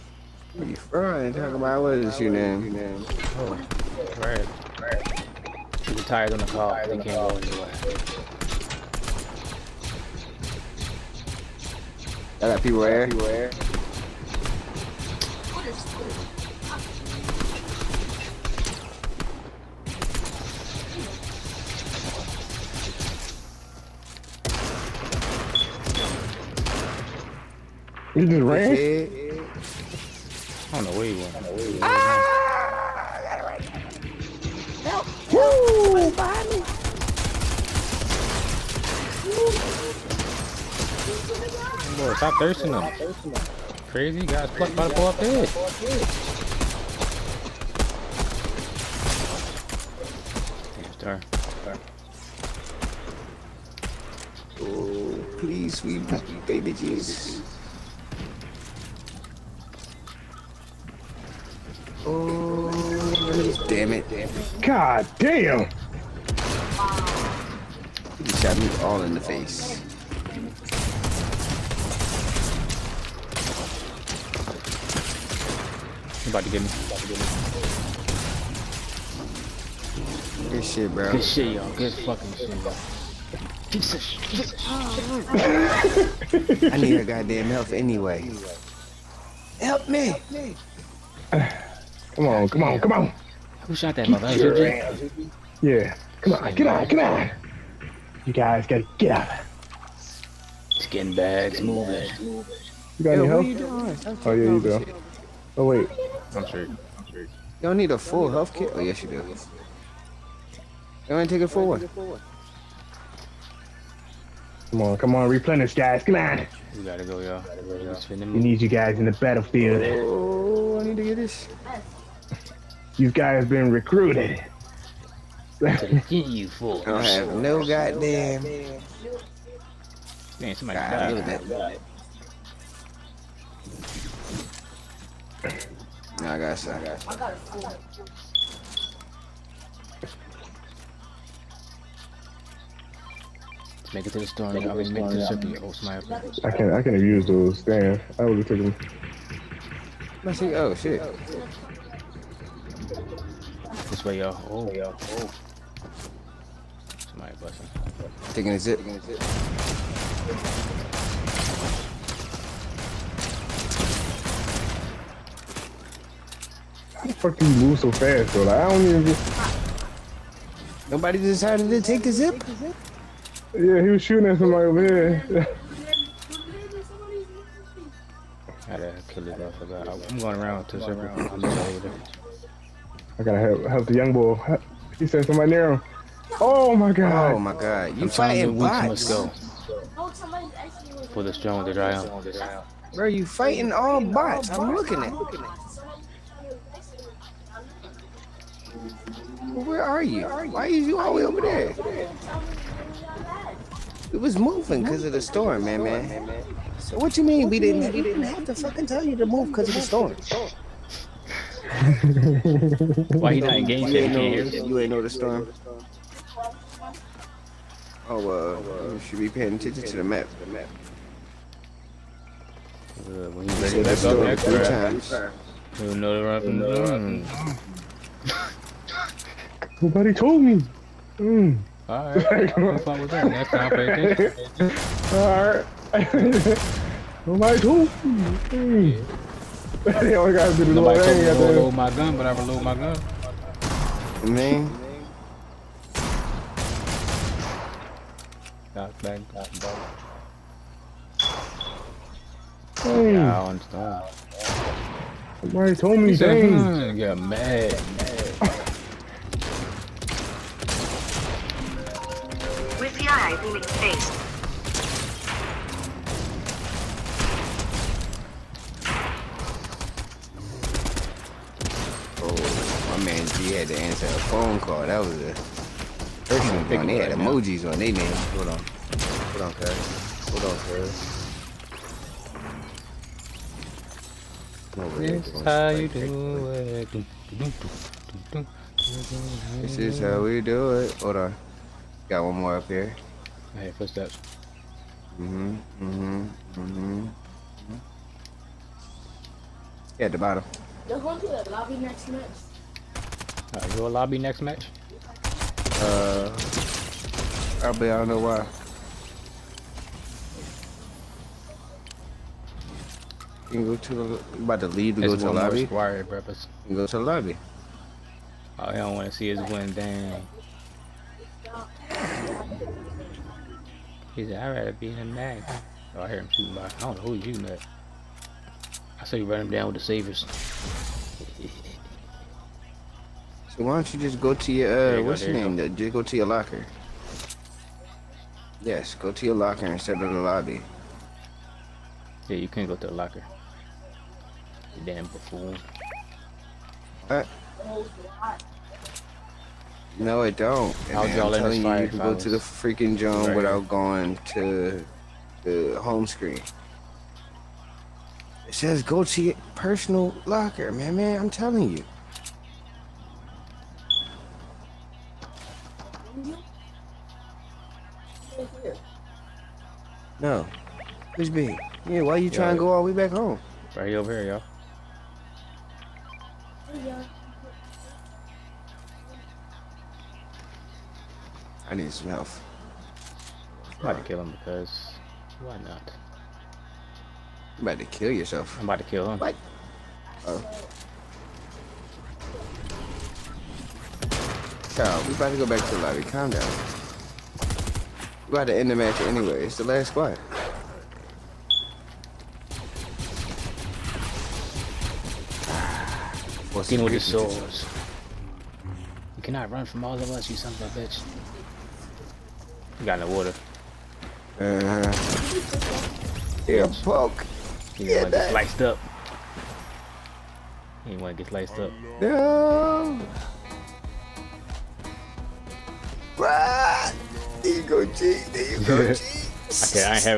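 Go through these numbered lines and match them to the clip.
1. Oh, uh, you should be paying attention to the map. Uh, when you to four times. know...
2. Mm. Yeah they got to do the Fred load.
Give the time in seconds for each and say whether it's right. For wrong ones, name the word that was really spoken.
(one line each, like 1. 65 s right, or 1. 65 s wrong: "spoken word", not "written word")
1. 218 s wrong: "three", not "four"
2. 238 s wrong: "Nobody", not "Fred".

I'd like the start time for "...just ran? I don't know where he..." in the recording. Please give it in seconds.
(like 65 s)
28 s.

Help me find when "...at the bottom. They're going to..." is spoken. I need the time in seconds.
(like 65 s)
300 s.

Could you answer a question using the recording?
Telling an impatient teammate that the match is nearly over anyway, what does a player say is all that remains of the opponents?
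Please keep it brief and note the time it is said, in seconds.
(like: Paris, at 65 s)
The last squad, at 399 s.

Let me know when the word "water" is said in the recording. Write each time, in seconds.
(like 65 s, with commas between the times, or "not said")
413 s.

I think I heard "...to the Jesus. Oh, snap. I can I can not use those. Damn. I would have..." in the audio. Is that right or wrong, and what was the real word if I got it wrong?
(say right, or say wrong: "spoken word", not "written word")
wrong: "Yeah", not "Jesus".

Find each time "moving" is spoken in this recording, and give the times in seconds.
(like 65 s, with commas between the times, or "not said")
204 s.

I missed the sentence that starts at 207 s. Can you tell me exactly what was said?
We didn't have to fucking tell you to move because of the storm.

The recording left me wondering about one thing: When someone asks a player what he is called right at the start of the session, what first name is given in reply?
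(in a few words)
Fred.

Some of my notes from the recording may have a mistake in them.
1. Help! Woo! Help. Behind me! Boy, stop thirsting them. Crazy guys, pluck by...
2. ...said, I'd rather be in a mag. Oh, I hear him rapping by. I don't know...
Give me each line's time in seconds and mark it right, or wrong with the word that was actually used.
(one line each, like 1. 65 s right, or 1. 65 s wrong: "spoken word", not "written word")
1. 34 s right
2. 324 s wrong: "shooting", not "rapping".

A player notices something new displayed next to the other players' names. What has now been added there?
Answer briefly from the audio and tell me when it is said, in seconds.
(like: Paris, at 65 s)
Emojis, at 277 s.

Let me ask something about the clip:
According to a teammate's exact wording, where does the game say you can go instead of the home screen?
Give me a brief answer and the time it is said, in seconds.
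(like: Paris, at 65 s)
Personal locker, at 359 s.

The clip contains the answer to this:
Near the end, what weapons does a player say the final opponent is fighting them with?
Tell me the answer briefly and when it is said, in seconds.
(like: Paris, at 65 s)
Swords, at 407 s.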